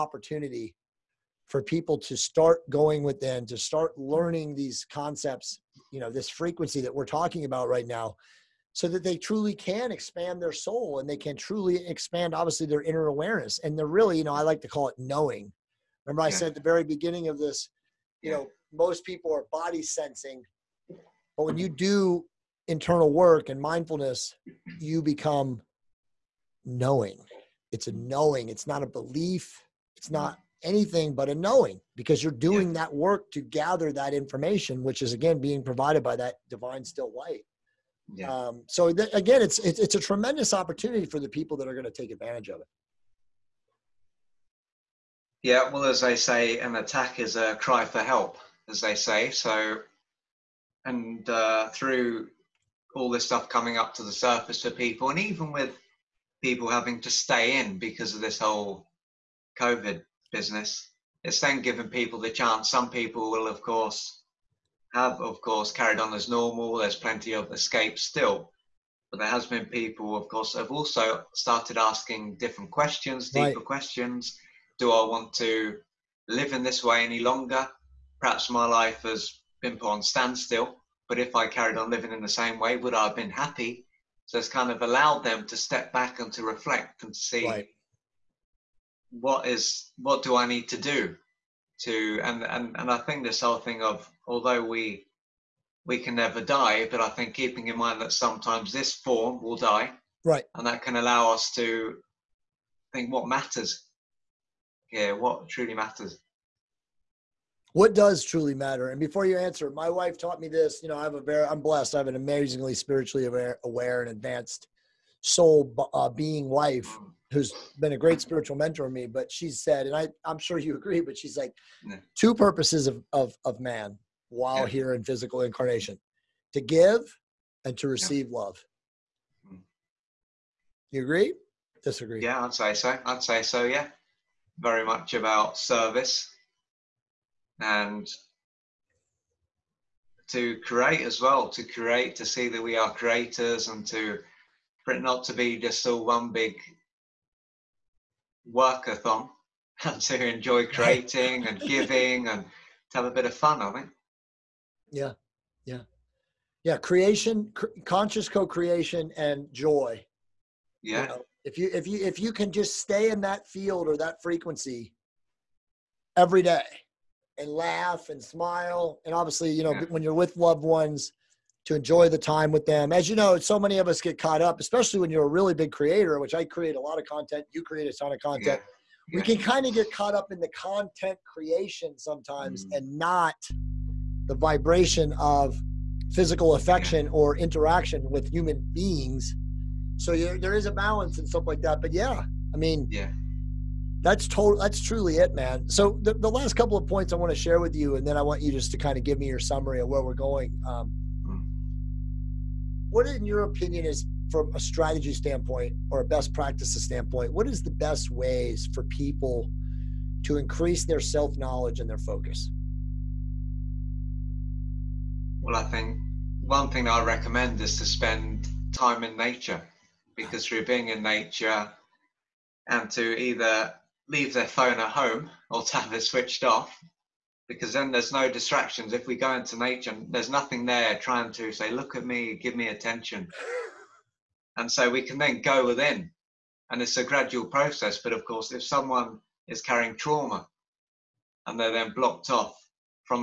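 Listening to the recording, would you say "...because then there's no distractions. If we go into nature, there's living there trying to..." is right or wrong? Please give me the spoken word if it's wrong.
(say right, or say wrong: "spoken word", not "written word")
wrong: "nothing", not "living".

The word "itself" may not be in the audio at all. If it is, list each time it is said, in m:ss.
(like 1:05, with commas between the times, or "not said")
not said.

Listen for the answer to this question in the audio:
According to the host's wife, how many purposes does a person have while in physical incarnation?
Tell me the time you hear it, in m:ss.
2:02.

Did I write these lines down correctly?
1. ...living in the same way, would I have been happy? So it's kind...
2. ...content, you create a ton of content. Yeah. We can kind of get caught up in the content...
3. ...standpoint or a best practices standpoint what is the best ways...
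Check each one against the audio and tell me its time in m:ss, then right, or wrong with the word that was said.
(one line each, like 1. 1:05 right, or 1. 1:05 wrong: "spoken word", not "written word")
1. 1:21 right
2. 2:57 right
3. 3:25 right.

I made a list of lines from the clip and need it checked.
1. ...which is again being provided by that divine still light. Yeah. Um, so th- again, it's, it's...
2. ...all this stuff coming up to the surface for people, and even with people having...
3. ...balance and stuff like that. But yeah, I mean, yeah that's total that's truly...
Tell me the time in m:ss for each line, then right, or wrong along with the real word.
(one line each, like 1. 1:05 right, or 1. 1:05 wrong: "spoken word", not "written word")
1. 0:34 right
2. 0:52 right
3. 3:10 right.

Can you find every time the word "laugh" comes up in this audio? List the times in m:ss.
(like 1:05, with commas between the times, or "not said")
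2:47.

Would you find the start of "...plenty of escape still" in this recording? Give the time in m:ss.
1:06.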